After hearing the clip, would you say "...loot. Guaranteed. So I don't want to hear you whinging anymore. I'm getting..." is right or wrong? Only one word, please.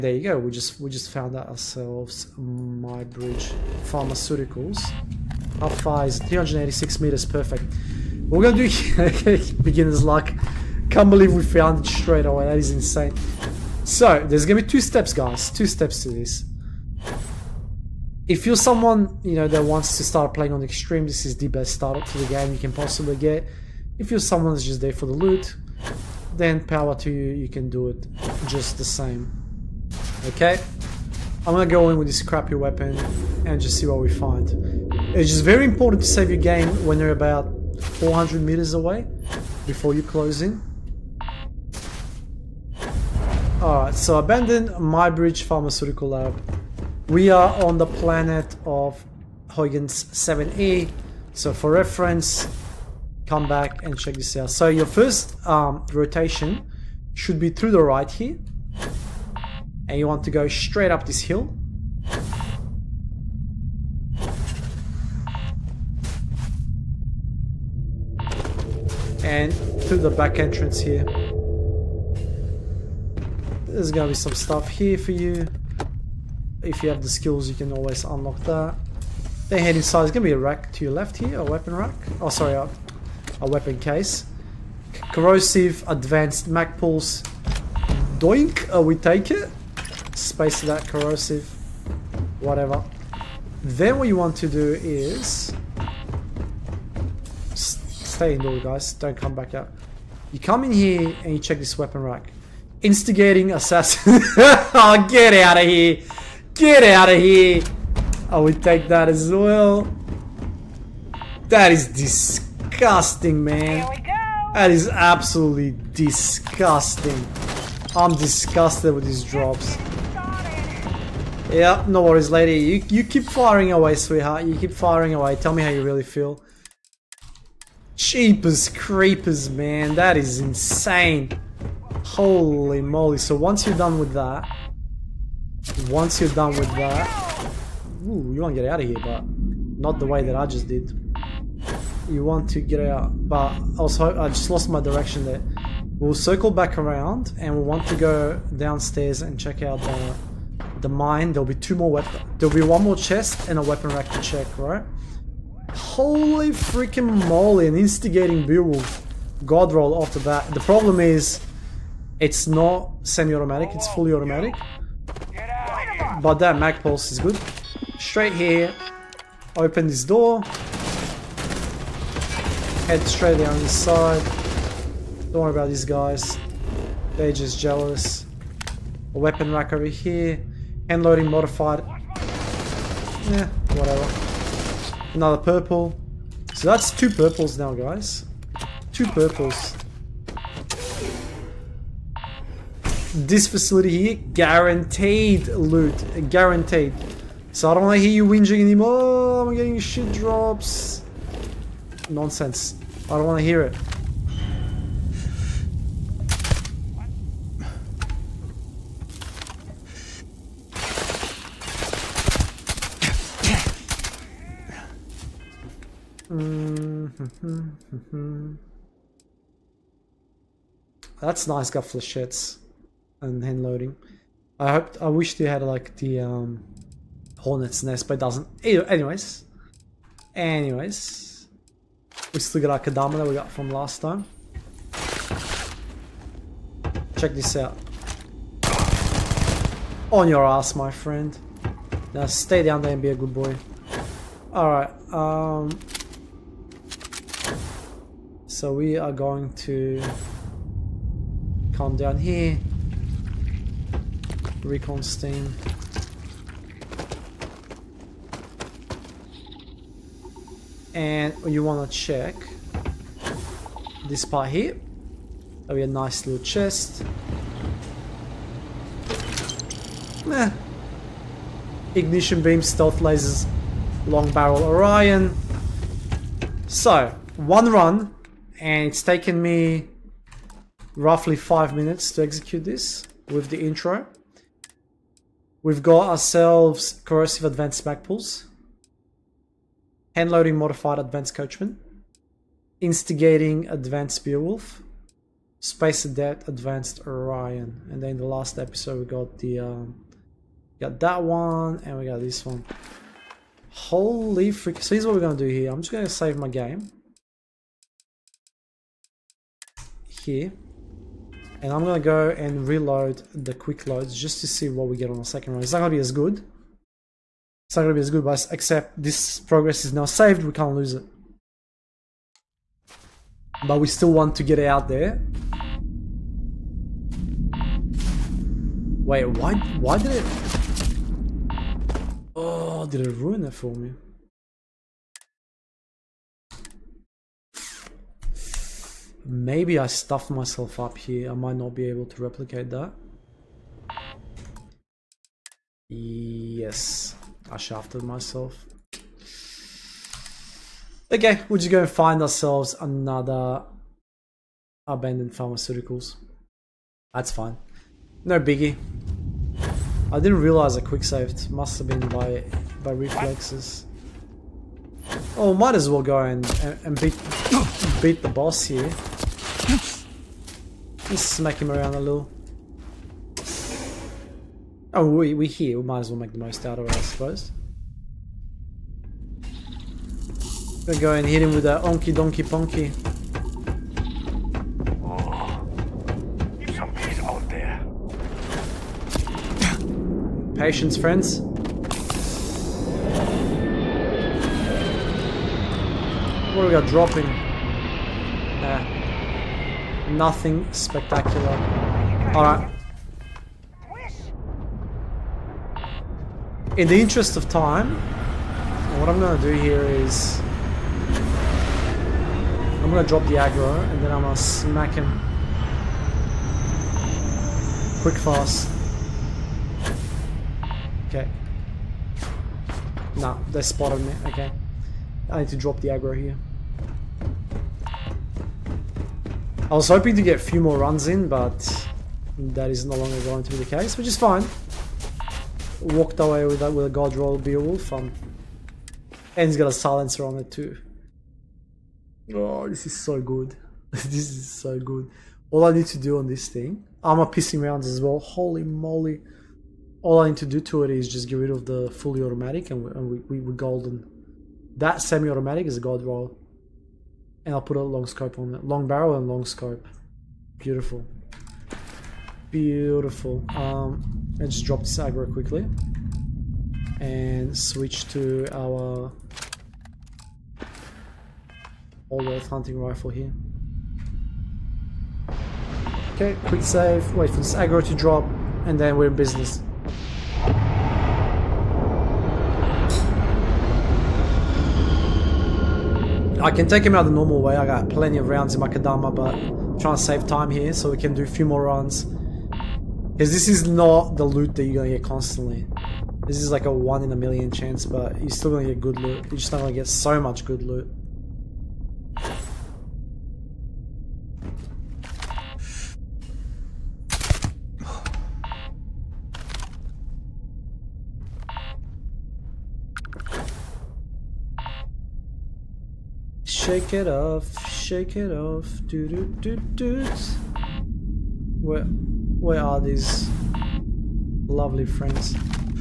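right.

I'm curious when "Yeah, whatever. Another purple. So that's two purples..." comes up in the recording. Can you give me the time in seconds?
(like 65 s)
183 s.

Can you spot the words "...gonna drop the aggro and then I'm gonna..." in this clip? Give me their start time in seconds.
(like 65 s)
412 s.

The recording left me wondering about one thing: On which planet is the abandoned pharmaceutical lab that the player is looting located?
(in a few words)
Huygens 7E.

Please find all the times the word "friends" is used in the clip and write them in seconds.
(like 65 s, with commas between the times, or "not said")
240 s, 390 s, 524 s.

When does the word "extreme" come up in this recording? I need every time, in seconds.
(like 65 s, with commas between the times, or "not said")
20 s.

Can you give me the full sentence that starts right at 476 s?
Okay, quick save, wait for this aggro to drop, and then we're in business.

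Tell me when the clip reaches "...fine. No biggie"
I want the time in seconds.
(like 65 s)
357 s.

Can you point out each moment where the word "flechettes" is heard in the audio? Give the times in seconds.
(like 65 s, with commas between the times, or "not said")
221 s.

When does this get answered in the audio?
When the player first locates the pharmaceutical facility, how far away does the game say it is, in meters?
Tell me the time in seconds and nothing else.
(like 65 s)
6 s.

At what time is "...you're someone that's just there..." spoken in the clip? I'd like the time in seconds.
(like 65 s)
24 s.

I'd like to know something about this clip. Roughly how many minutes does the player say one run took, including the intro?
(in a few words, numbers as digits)
5 minutes.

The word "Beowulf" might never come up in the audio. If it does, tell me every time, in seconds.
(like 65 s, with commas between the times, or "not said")
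158 s, 294 s, 437 s.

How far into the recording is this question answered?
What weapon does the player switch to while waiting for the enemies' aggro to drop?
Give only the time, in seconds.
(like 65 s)
472 s.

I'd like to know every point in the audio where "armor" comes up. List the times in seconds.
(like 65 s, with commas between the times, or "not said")
447 s.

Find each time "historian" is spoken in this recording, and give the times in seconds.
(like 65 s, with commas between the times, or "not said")
not said.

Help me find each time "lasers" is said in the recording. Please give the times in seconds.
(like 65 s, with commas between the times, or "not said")
272 s.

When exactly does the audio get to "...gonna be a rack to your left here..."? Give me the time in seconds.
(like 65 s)
80 s.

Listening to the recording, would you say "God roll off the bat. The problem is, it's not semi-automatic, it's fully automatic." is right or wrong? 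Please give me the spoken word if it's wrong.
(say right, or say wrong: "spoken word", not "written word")
right.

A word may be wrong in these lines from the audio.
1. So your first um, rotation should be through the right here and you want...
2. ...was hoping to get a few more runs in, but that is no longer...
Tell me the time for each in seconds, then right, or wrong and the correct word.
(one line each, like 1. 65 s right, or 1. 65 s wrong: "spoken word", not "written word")
1. 54 s right
2. 429 s right.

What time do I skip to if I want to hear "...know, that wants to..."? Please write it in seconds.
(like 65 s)
19 s.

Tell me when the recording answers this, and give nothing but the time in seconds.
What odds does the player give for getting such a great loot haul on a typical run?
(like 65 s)
496 s.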